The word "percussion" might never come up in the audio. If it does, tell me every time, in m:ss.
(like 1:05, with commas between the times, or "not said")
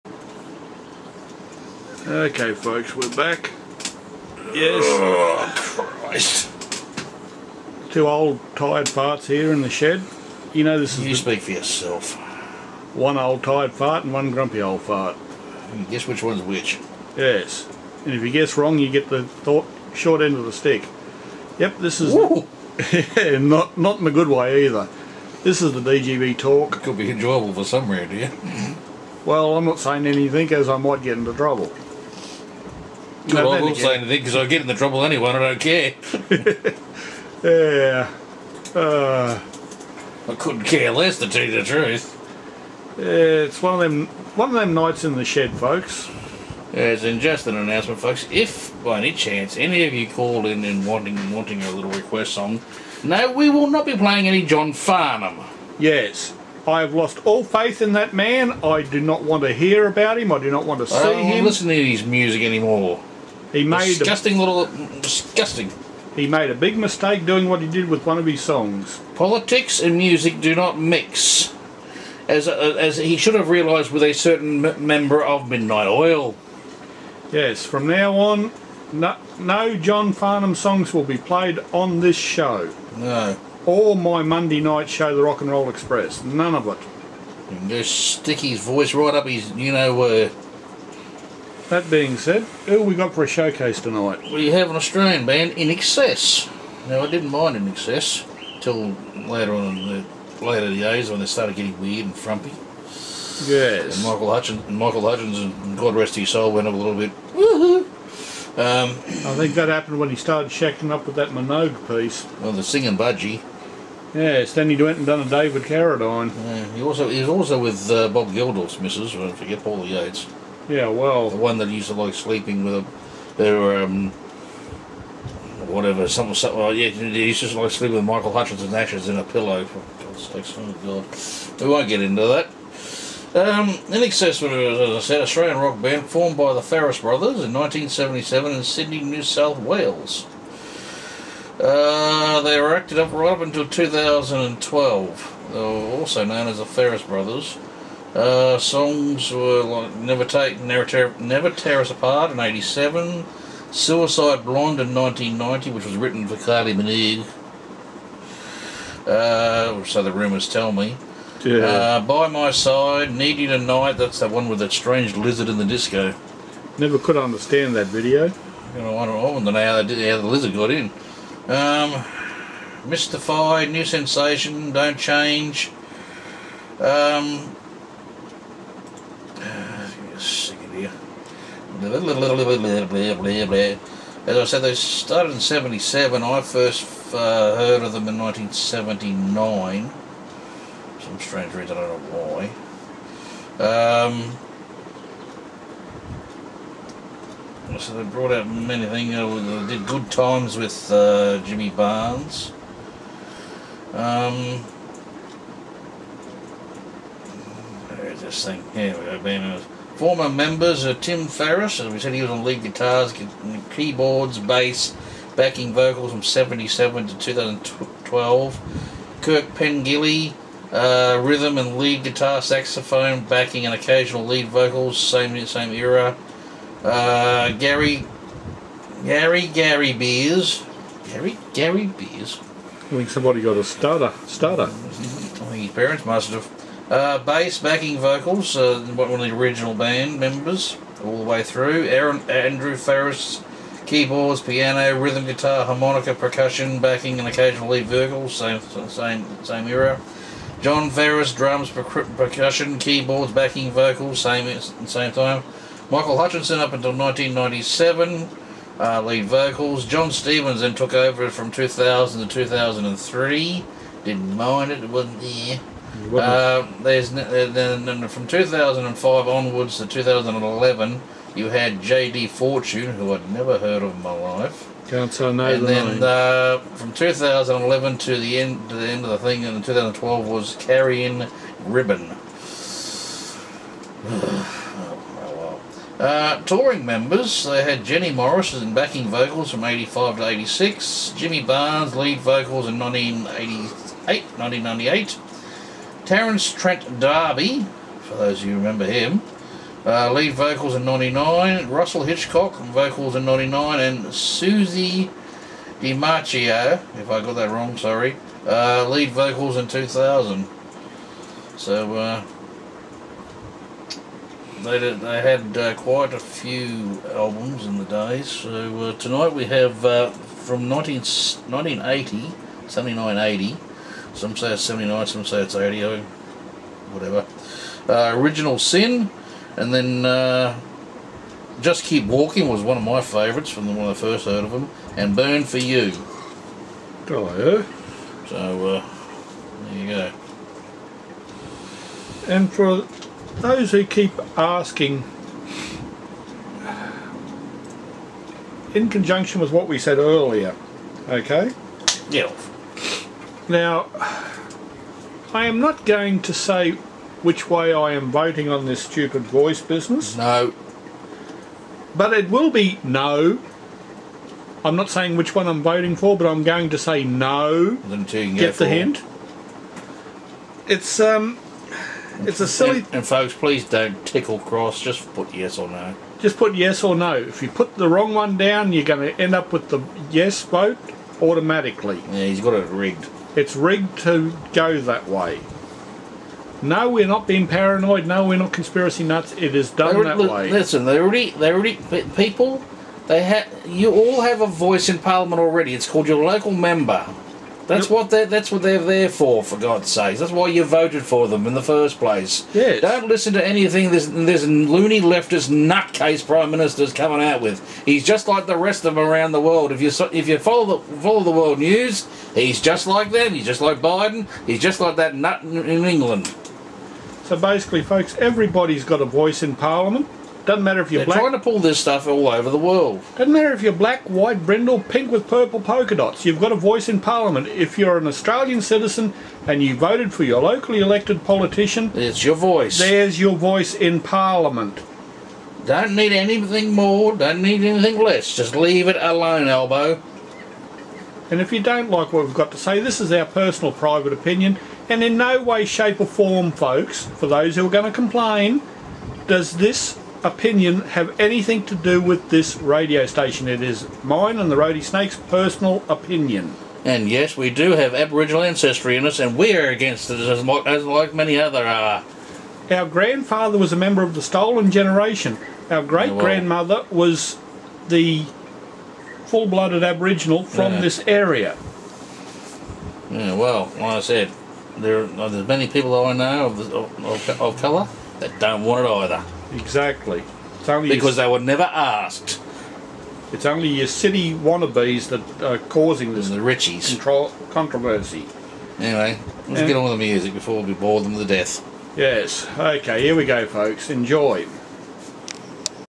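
4:06, 4:11.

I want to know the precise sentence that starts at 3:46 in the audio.
Uh, Gary, Gary, Gary Beers, Gary, Gary Beers.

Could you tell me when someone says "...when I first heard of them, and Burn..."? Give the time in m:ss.
5:33.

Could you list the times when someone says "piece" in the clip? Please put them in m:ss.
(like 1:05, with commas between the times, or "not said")
1:51.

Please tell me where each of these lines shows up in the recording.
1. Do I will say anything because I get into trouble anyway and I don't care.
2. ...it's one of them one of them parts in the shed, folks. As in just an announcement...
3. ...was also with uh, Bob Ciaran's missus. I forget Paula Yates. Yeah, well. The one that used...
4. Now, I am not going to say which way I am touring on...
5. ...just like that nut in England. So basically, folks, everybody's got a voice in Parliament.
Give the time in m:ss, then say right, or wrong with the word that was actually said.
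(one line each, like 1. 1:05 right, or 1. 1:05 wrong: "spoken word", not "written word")
1. 0:33 right
2. 0:43 wrong: "nights", not "parts"
3. 1:57 wrong: "Geldof", not "Ciaran"
4. 5:53 wrong: "voting", not "touring"
5. 6:54 right.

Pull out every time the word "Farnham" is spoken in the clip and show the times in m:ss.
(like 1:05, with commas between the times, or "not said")
0:54, 1:20.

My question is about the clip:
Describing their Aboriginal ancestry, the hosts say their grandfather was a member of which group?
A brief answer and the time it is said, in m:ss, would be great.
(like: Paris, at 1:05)
The Stolen Generation, at 7:44.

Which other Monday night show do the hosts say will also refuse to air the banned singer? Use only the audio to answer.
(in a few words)
The Rock and Roll Express.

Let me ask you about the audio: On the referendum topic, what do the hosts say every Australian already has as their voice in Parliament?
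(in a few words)
Your local member.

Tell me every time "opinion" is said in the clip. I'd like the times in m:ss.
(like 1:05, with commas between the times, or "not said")
7:24, 7:30, 7:35.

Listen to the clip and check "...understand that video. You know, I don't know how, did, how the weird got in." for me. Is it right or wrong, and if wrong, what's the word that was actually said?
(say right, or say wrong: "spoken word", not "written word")
wrong: "lizard", not "weird".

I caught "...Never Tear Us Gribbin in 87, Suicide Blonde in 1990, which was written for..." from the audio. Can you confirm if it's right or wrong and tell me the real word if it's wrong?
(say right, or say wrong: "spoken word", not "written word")
wrong: "Apart", not "Gribbin".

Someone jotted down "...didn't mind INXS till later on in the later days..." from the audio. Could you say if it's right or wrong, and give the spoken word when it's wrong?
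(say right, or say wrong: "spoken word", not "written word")
right.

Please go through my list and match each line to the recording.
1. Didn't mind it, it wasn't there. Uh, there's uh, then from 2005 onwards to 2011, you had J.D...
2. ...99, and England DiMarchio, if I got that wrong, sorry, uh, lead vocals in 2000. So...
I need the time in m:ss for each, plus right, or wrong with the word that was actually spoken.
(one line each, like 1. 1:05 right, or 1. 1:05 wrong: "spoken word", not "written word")
1. 4:24 right
2. 5:03 wrong: "Susie", not "England".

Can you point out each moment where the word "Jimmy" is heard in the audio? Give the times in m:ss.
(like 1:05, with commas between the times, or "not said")
3:21, 4:51.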